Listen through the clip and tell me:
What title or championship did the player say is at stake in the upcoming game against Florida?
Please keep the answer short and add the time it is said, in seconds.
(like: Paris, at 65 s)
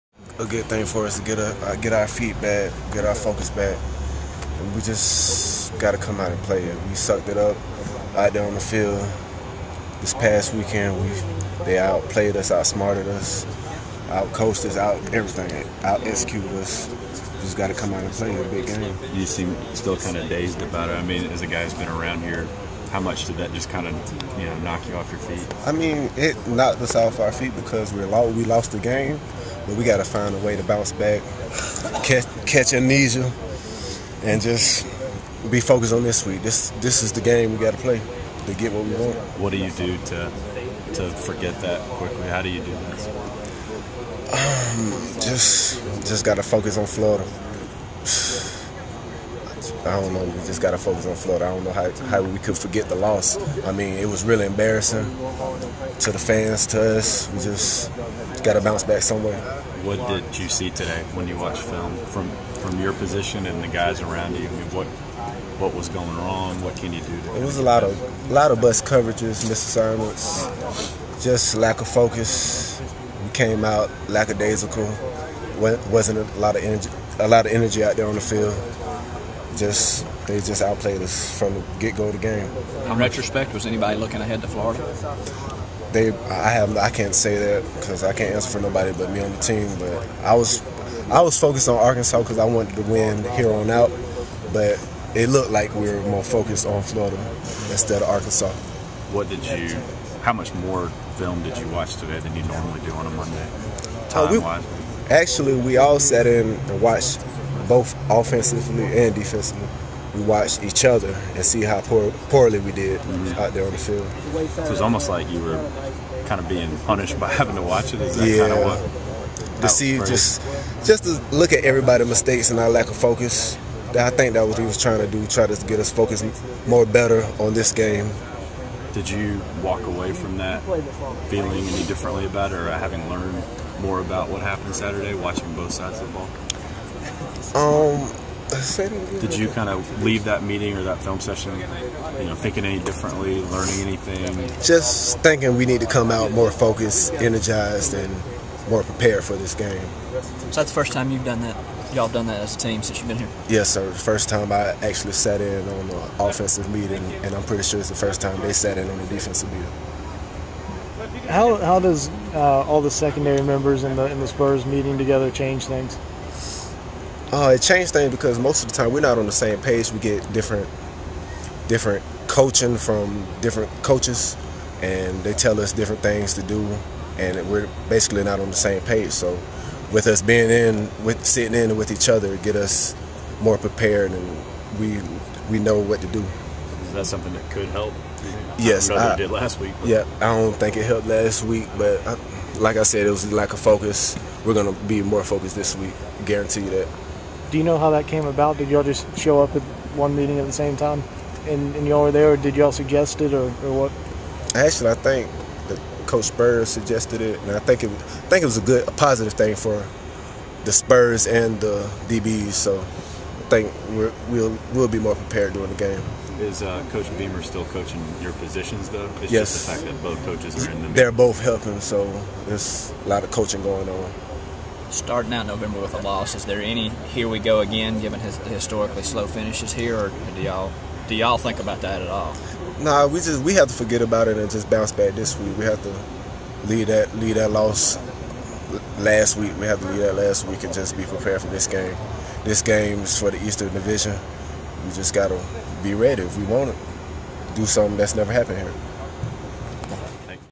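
Eastern Division, at 243 s.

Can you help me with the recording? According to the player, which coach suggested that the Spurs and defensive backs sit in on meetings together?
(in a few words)
Coach Spurrier.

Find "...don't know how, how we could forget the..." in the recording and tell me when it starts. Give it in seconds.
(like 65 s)
51 s.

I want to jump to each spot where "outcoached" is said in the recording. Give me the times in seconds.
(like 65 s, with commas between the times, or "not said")
14 s.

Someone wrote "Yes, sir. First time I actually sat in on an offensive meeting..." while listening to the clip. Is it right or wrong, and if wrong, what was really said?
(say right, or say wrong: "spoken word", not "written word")
right.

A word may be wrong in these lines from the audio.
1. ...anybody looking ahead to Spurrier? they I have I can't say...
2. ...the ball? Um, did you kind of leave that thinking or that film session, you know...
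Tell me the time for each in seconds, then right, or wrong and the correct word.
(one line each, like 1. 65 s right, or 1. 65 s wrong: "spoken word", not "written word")
1. 83 s wrong: "Florida", not "Spurrier"
2. 136 s wrong: "meeting", not "thinking".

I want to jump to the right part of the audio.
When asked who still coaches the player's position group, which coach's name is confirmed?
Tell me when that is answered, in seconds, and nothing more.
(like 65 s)
216 s.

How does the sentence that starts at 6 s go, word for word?
We sucked it up out there on the field this past weekend.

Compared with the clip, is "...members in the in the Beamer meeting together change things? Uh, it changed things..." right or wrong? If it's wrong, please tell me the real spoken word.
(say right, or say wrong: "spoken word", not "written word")
wrong: "Spurs", not "Beamer".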